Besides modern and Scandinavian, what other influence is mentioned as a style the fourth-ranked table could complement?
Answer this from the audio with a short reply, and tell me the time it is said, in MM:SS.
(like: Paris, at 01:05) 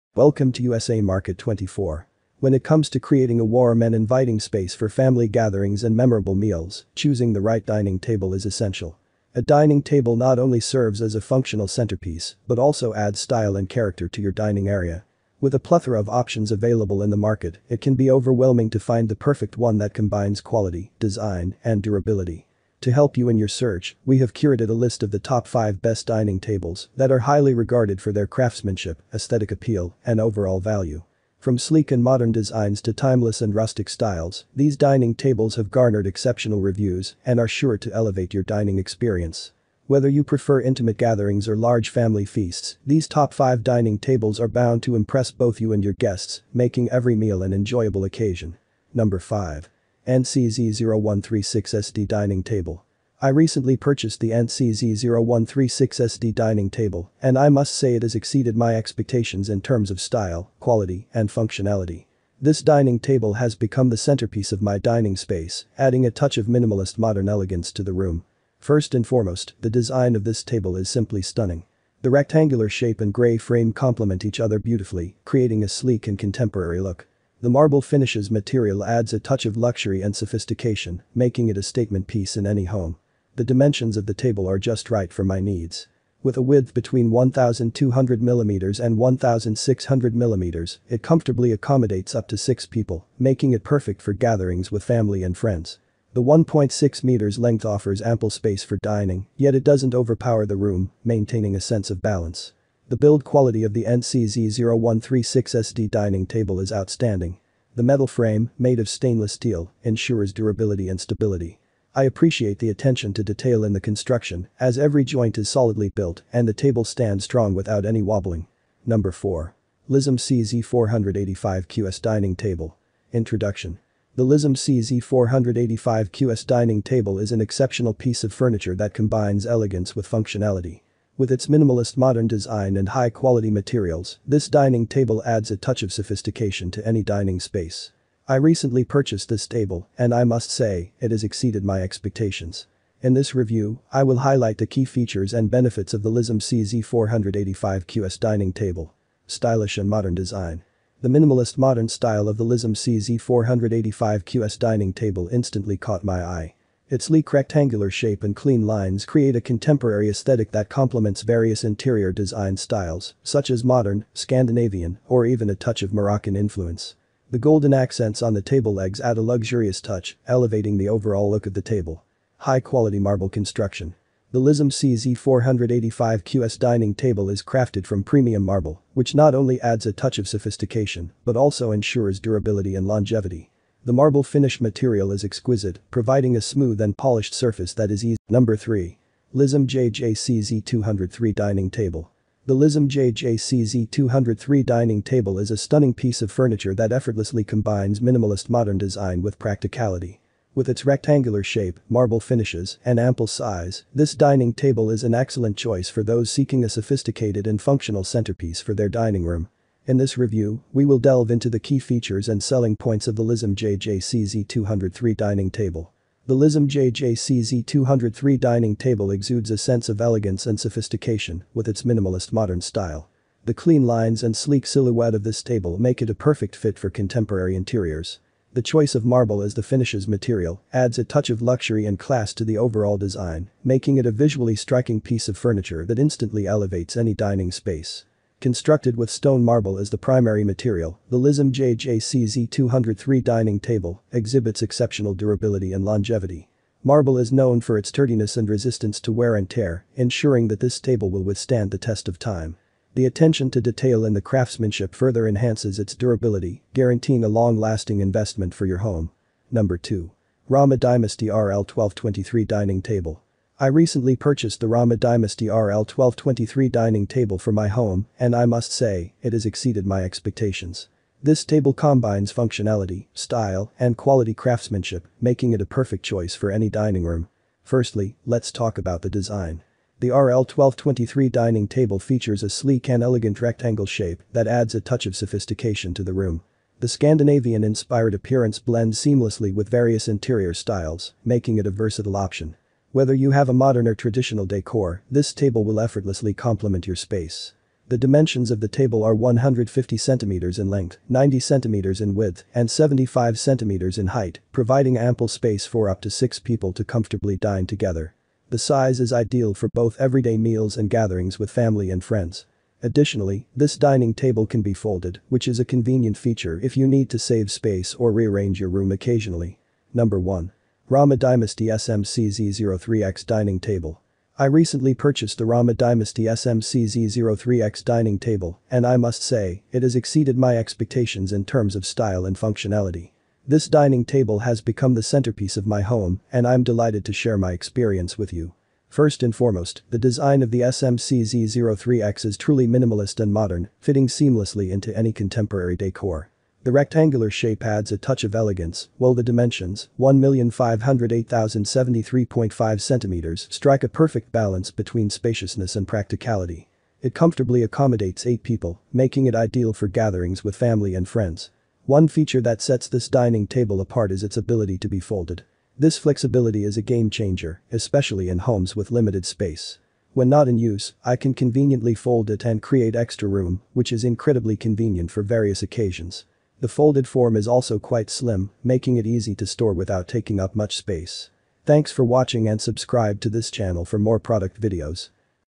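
Moroccan, at 02:45.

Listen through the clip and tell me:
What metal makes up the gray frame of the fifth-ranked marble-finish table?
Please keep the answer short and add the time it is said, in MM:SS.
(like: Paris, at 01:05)
stainless steel, at 01:48.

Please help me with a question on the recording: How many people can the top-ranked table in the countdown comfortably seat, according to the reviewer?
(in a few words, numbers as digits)
8.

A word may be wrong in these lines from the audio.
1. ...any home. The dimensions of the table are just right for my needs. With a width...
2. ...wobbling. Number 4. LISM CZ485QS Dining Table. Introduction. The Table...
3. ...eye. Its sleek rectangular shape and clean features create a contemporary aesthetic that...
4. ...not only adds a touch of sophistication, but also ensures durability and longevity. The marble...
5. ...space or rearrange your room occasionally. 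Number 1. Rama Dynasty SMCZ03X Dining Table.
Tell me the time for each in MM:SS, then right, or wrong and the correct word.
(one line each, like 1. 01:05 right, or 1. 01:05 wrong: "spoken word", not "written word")
1. 01:22 right
2. 01:58 wrong: "LISM", not "Table"
3. 02:36 wrong: "lines", not "features"
4. 02:59 right
5. 05:17 right.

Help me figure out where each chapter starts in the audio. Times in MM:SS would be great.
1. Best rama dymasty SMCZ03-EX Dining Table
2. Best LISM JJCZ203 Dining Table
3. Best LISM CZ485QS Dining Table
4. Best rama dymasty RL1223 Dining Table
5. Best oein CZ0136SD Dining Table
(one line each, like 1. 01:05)
1. 05:19
2. 03:08
3. 01:58
4. 04:19
5. 00:48.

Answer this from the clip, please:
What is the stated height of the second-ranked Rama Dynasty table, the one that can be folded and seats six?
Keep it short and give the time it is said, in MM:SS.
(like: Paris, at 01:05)
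75 centimeters, at 05:02.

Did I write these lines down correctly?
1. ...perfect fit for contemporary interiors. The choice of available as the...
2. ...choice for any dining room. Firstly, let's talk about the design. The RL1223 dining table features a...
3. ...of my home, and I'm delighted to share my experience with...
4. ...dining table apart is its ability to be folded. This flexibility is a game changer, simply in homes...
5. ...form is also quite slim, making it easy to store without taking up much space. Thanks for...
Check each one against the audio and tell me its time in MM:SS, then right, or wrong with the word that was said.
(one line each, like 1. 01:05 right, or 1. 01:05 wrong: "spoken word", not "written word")
1. 03:46 wrong: "marble", not "available"
2. 04:36 right
3. 05:35 right
4. 06:03 wrong: "especially", not "simply"
5. 06:17 right.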